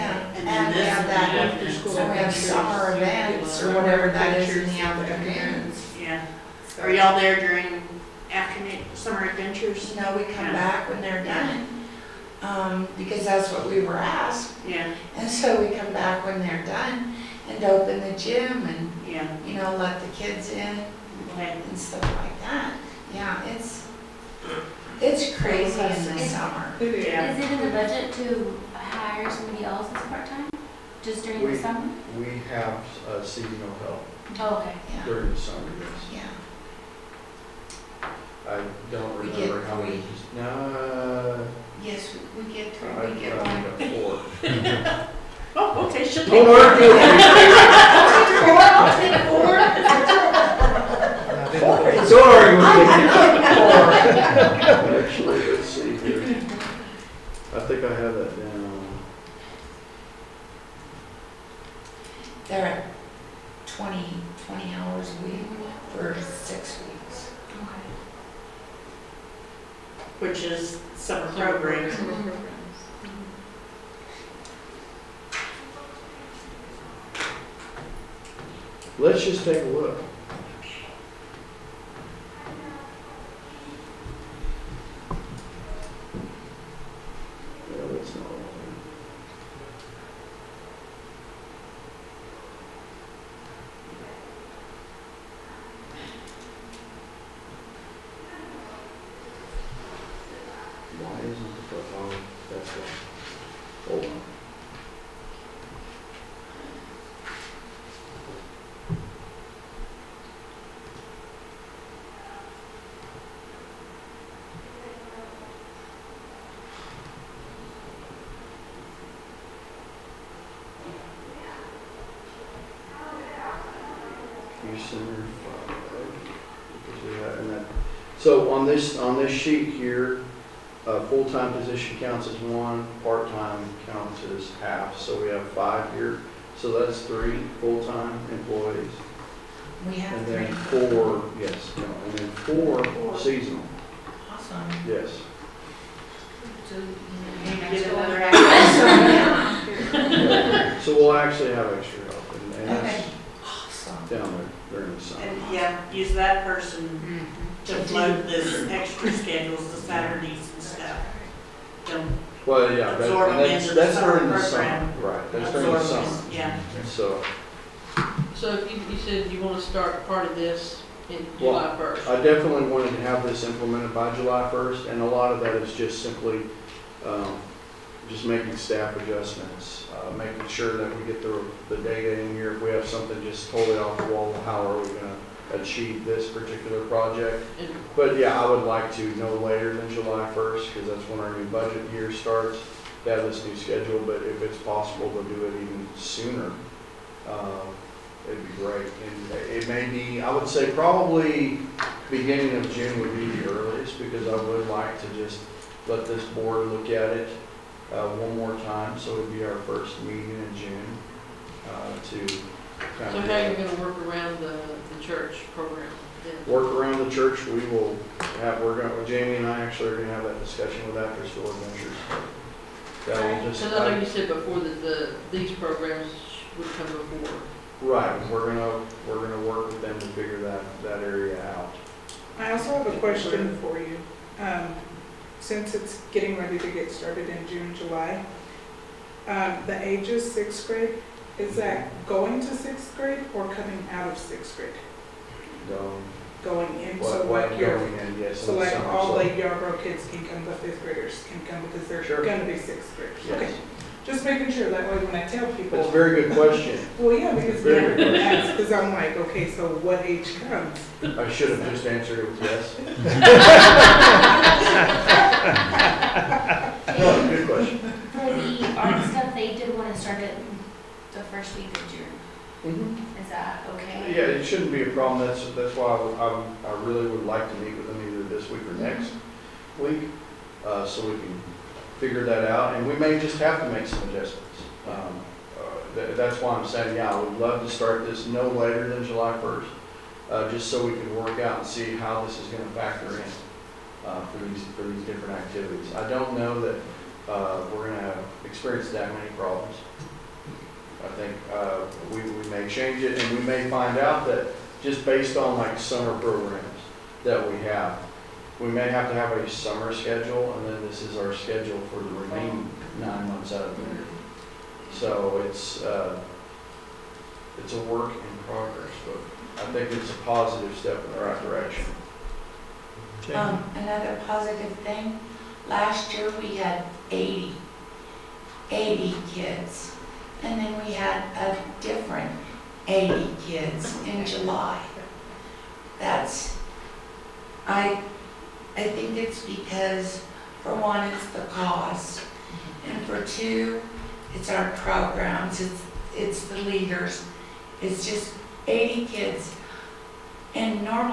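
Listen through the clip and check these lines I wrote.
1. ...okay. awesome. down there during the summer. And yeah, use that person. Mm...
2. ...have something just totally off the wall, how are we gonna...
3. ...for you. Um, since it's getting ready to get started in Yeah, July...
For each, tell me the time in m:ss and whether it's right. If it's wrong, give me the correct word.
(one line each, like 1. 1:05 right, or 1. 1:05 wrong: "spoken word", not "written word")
1. 2:32 right
2. 3:02 right
3. 3:53 wrong: "June", not "Yeah".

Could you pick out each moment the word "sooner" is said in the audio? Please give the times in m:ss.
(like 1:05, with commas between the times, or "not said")
3:15.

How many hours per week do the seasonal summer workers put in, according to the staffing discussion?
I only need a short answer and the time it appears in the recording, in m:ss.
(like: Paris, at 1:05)
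20, at 1:03.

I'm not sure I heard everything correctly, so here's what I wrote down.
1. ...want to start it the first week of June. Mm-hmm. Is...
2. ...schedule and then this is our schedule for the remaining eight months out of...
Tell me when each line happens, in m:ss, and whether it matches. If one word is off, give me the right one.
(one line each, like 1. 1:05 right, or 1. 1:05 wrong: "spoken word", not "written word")
1. 4:29 right
2. 5:09 wrong: "nine", not "eight".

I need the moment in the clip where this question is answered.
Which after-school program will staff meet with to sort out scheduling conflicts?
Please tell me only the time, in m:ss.
3:41.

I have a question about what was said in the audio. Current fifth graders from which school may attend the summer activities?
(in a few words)
Yarbro.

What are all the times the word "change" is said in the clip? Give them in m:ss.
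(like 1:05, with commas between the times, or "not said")
5:02.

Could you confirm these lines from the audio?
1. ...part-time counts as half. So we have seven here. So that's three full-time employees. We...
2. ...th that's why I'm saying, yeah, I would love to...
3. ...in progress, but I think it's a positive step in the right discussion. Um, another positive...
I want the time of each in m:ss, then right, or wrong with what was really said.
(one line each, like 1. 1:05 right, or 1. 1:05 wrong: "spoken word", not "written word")
1. 2:13 wrong: "five", not "seven"
2. 4:45 right
3. 5:18 wrong: "direction", not "discussion".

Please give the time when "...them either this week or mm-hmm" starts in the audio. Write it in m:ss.
4:37.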